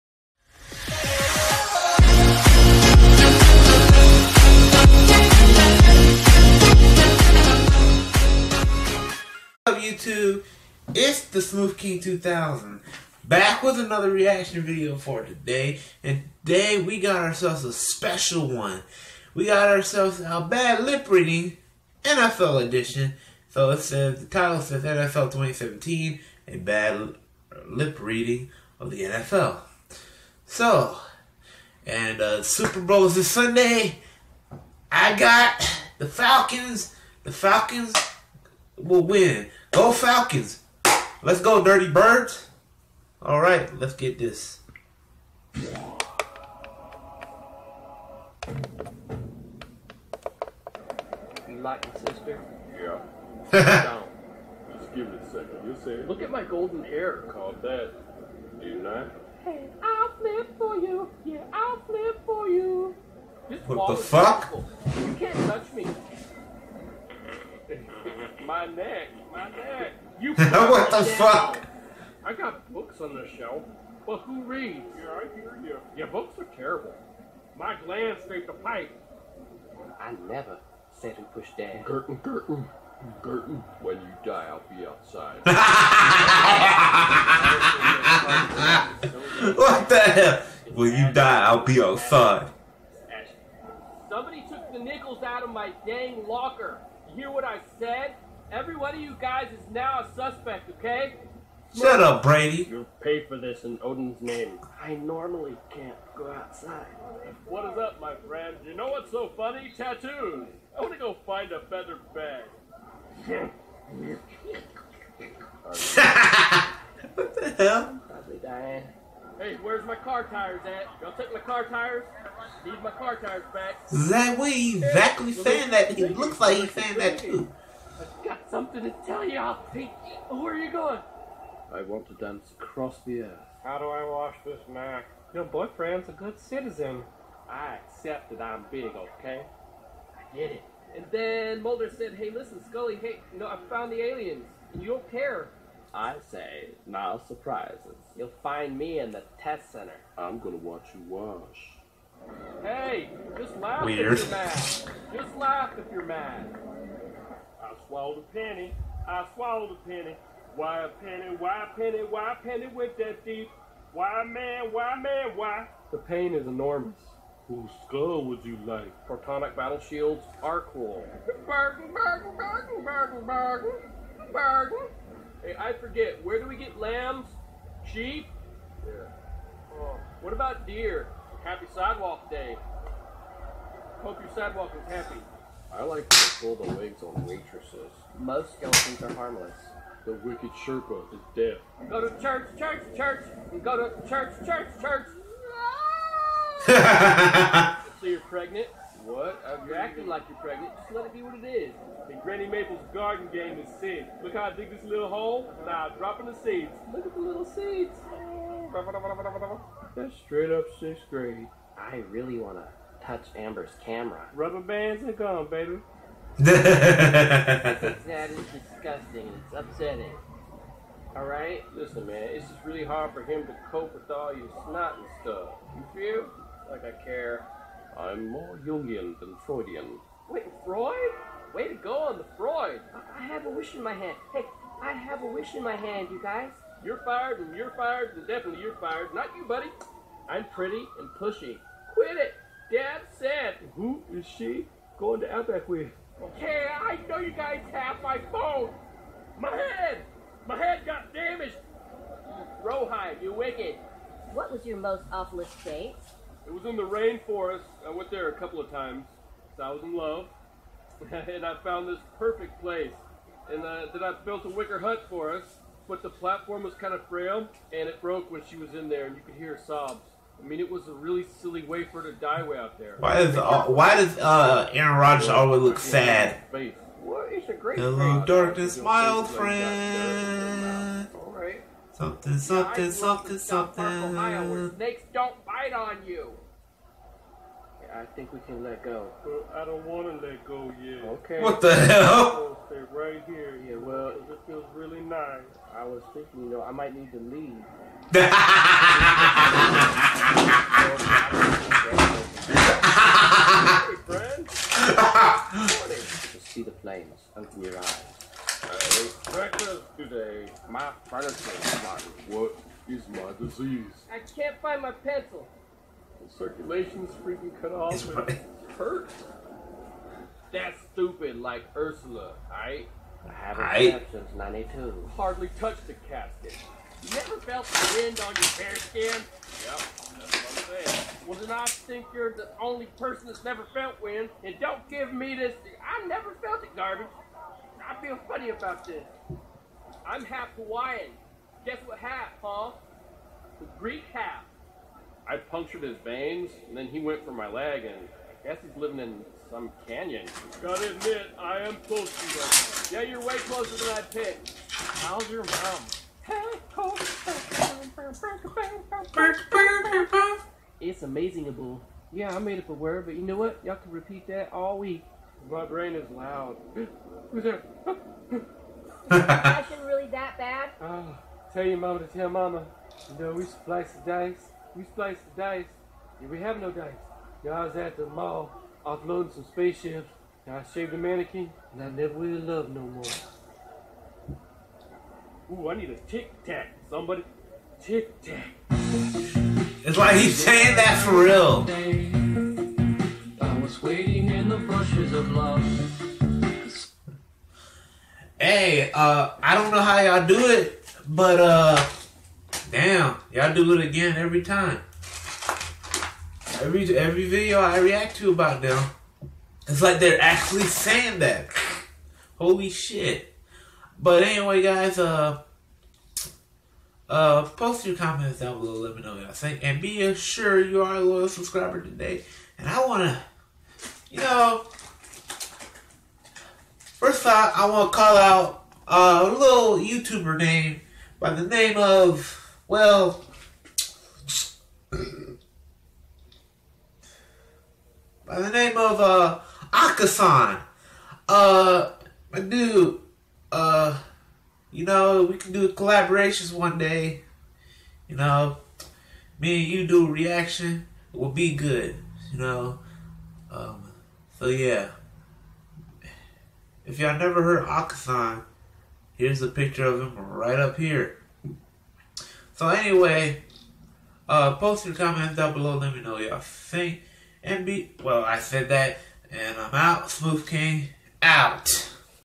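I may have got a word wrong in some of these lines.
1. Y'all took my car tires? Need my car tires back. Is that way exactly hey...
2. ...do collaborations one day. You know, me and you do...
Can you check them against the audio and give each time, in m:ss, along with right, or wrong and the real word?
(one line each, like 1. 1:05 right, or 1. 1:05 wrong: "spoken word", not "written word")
1. 2:01 right
2. 7:25 right.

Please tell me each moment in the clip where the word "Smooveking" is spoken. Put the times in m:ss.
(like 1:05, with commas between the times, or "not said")
0:11, 7:50.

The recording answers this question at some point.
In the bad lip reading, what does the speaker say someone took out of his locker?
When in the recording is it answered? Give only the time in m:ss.
1:34.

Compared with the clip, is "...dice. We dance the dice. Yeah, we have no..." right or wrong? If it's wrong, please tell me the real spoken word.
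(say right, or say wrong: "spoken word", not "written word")
wrong: "splice", not "dance".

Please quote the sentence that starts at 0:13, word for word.
Back with another reaction video for today.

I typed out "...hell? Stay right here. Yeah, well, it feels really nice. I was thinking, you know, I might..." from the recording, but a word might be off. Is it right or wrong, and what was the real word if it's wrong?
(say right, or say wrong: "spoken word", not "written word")
right.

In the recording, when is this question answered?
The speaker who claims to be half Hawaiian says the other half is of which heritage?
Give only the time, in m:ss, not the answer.
5:43.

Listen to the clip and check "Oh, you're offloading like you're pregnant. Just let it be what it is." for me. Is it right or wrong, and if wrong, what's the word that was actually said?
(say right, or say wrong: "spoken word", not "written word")
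wrong: "acting", not "offloading".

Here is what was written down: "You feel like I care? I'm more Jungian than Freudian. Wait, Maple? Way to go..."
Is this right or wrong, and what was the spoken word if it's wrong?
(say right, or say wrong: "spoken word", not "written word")
wrong: "Freud", not "Maple".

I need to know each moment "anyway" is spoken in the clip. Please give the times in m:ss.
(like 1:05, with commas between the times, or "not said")
6:54, 7:42.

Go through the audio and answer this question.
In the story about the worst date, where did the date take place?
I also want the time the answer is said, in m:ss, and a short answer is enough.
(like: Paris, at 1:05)
The rainforest, at 4:16.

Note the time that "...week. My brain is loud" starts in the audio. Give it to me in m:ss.
6:04.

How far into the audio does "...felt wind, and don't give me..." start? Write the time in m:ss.
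5:33.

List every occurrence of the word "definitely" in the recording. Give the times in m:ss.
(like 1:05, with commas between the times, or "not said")
3:58.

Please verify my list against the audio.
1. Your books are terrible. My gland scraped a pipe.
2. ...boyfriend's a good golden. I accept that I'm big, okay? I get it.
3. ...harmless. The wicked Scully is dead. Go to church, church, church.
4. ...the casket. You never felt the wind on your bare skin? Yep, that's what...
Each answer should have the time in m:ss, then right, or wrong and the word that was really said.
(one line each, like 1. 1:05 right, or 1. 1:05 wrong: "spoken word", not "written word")
1. 1:15 right
2. 2:15 wrong: "citizen", not "golden"
3. 3:09 wrong: "Sherpa", not "Scully"
4. 5:25 right.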